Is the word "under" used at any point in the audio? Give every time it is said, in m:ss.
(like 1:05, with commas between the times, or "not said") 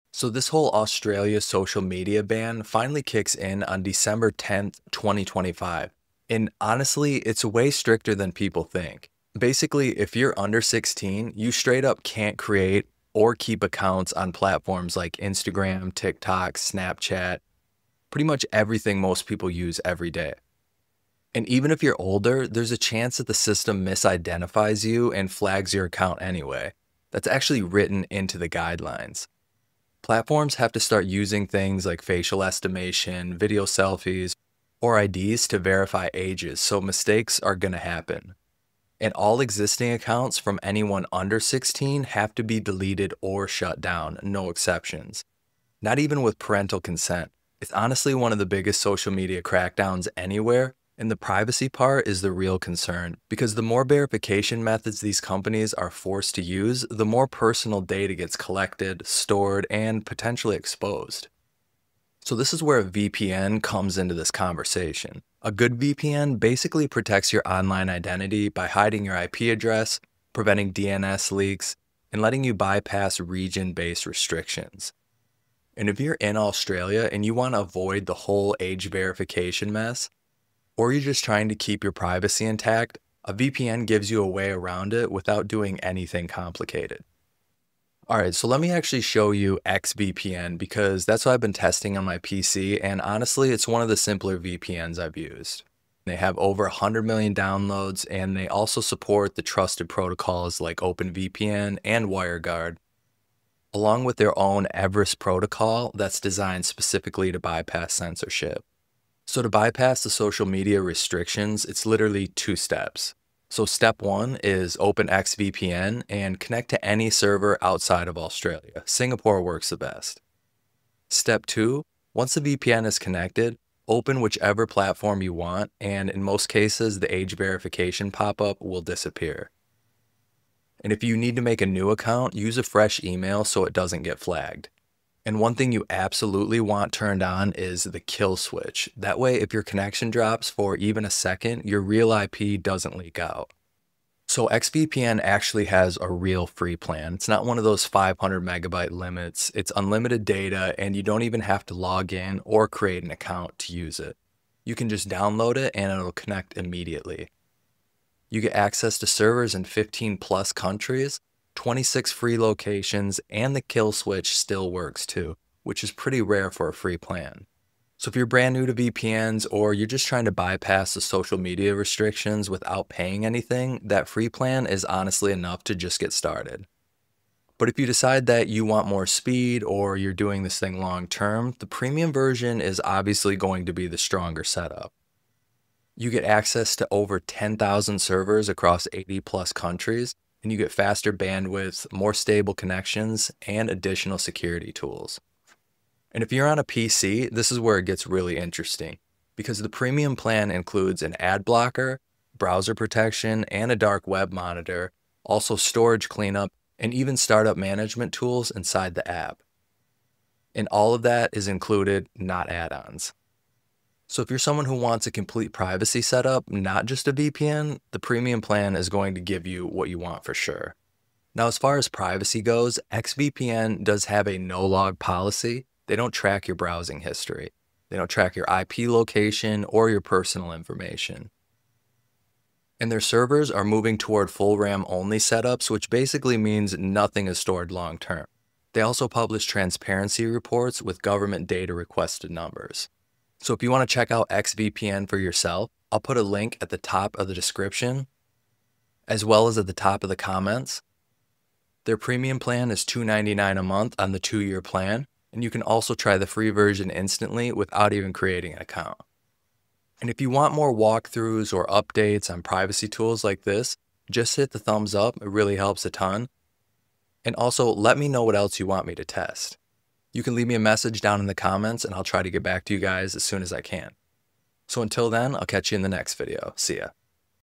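0:10, 0:41.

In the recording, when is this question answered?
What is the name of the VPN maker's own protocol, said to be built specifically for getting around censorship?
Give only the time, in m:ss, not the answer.
1:44.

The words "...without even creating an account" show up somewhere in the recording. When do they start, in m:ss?
4:17.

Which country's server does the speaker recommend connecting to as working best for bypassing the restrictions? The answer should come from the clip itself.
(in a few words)
Singapore.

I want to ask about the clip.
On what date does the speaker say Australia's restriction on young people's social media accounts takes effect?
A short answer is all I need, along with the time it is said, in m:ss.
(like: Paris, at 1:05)
December 10th, 2025, at 0:03.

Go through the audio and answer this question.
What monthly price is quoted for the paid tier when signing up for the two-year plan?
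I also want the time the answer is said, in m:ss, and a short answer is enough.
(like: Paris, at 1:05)
$2.99, at 4:12.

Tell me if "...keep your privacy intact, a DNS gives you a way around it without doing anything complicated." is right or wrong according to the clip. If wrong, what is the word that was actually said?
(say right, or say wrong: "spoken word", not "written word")
wrong: "VPN", not "DNS".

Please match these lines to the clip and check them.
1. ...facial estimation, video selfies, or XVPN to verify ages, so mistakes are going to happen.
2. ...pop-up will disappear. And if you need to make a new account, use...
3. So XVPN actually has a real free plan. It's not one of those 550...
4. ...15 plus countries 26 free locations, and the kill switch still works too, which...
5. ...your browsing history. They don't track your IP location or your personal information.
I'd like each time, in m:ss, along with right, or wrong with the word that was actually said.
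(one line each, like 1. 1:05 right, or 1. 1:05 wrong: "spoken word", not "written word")
1. 0:32 wrong: "IDs", not "XVPN"
2. 2:08 right
3. 2:24 wrong: "500", not "550"
4. 2:39 right
5. 3:46 right.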